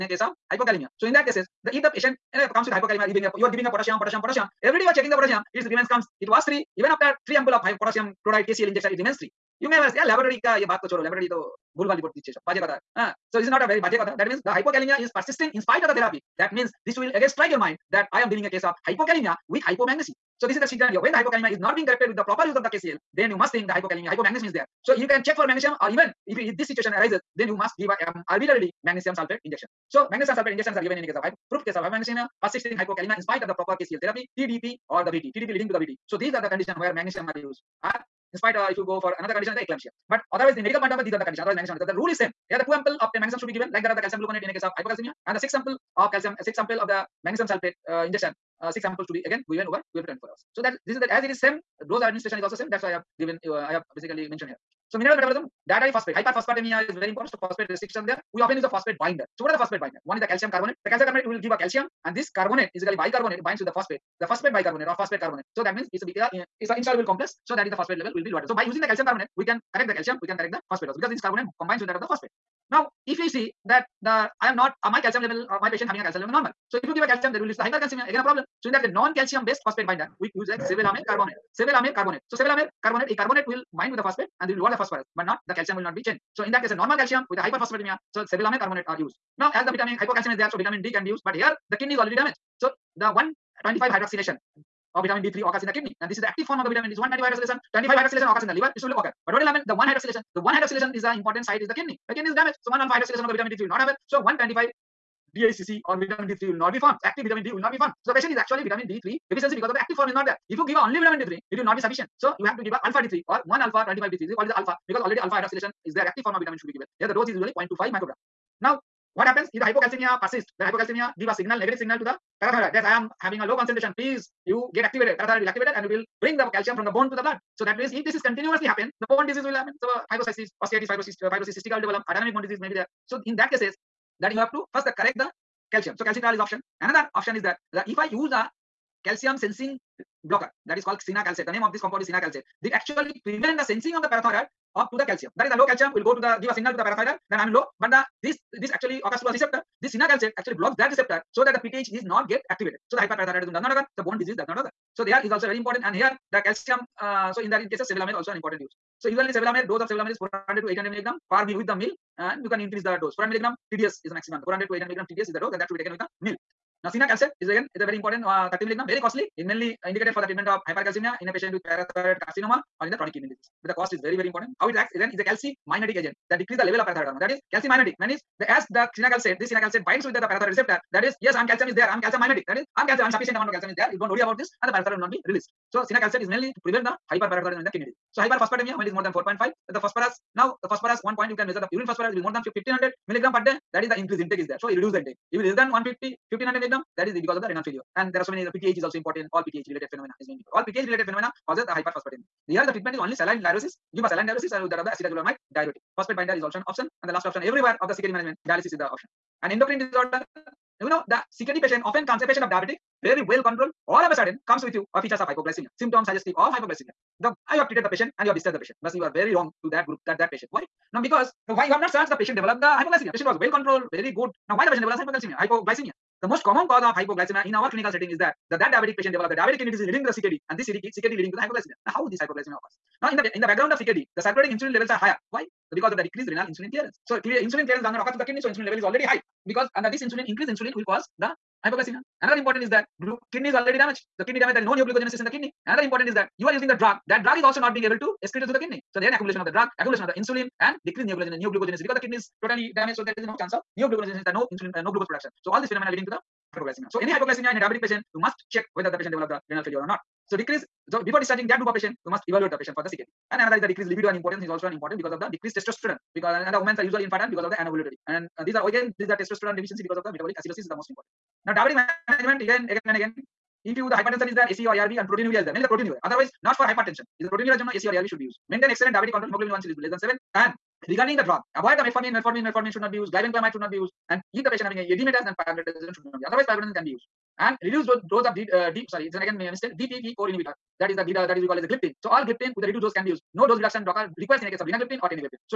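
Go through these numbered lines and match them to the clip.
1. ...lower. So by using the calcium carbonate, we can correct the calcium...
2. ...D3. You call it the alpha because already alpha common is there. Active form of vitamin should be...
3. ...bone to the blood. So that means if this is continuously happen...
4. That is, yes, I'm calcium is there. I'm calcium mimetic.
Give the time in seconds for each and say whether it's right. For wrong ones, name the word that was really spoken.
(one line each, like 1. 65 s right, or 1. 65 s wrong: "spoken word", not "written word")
1. 68 s right
2. 114 s wrong: "hydroxylation", not "common"
3. 126 s right
4. 180 s right.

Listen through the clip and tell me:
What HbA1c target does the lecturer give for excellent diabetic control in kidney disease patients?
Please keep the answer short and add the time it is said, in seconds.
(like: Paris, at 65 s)
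less than 7, at 279 s.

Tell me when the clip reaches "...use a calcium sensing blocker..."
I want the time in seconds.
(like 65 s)
138 s.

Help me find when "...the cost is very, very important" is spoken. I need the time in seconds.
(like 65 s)
173 s.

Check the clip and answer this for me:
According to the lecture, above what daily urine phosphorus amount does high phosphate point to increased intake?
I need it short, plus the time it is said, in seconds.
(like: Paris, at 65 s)
1500 milligram per day, at 192 s.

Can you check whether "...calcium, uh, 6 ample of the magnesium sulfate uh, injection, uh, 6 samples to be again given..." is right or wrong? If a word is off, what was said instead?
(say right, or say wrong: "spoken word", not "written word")
right.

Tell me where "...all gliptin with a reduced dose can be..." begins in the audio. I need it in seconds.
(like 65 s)
292 s.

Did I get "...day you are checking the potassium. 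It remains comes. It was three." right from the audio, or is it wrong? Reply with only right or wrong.
right.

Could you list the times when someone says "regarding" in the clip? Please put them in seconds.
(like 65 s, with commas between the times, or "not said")
280 s.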